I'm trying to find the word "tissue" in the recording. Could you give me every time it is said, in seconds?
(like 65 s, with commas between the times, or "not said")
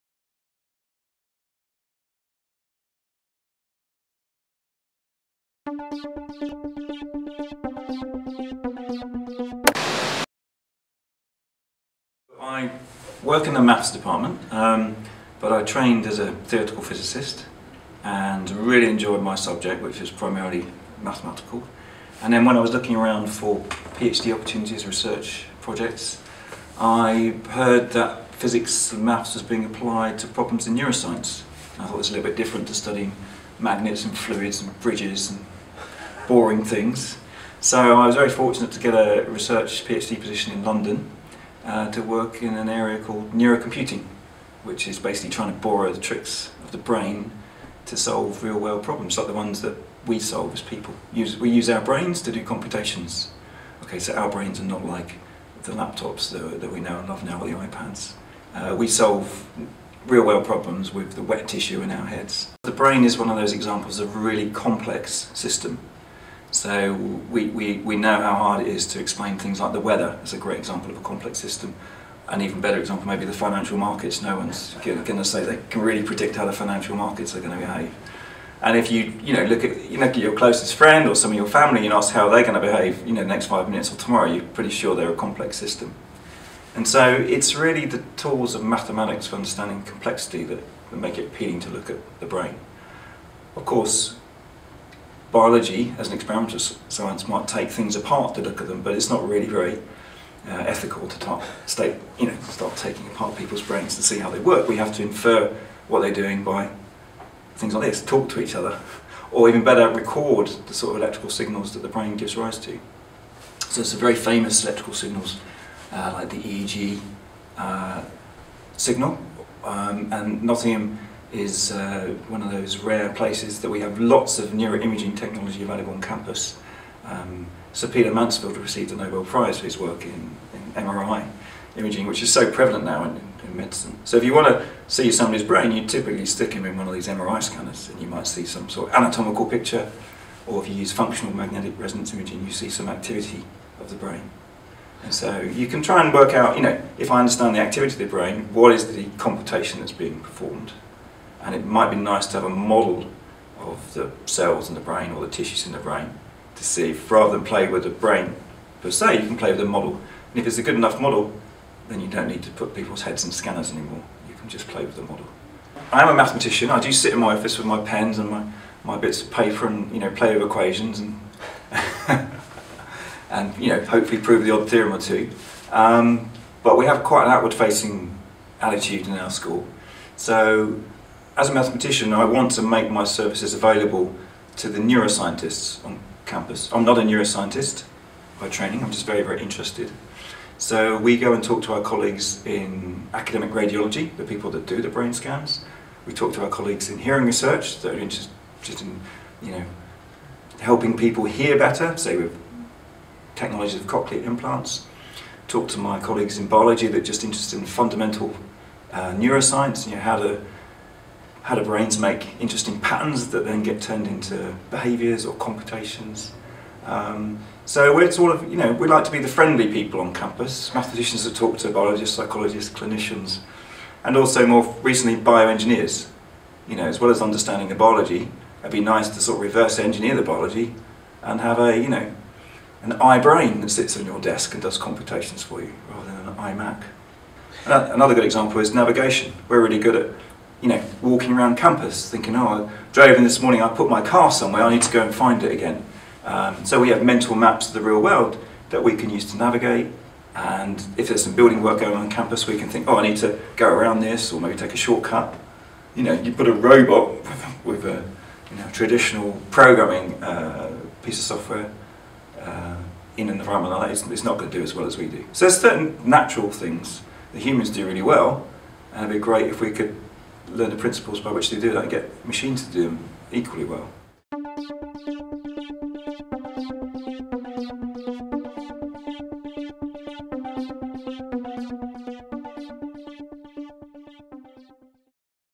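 61 s, 155 s.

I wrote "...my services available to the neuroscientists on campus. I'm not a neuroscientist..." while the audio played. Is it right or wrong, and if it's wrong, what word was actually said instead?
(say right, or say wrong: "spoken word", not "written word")
right.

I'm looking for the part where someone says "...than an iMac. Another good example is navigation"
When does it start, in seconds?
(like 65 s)
236 s.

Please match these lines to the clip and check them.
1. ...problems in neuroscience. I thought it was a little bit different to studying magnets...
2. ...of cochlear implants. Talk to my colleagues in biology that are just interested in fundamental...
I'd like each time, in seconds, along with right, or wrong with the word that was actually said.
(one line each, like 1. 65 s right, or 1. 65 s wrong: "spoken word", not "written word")
1. 30 s right
2. 203 s right.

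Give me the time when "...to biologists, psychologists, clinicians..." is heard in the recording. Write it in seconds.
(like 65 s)
221 s.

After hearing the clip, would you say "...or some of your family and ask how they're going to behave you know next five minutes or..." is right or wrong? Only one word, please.
right.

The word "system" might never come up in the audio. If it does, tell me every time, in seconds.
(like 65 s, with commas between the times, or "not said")
65 s, 71 s, 85 s.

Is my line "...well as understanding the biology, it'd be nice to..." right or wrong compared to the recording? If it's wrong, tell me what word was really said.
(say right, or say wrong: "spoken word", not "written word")
right.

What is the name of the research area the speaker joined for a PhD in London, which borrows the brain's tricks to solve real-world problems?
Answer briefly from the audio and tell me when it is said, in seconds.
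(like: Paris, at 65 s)
Neurocomputing, at 43 s.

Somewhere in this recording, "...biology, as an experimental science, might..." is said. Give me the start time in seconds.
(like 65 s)
95 s.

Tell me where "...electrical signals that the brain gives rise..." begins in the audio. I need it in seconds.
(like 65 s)
111 s.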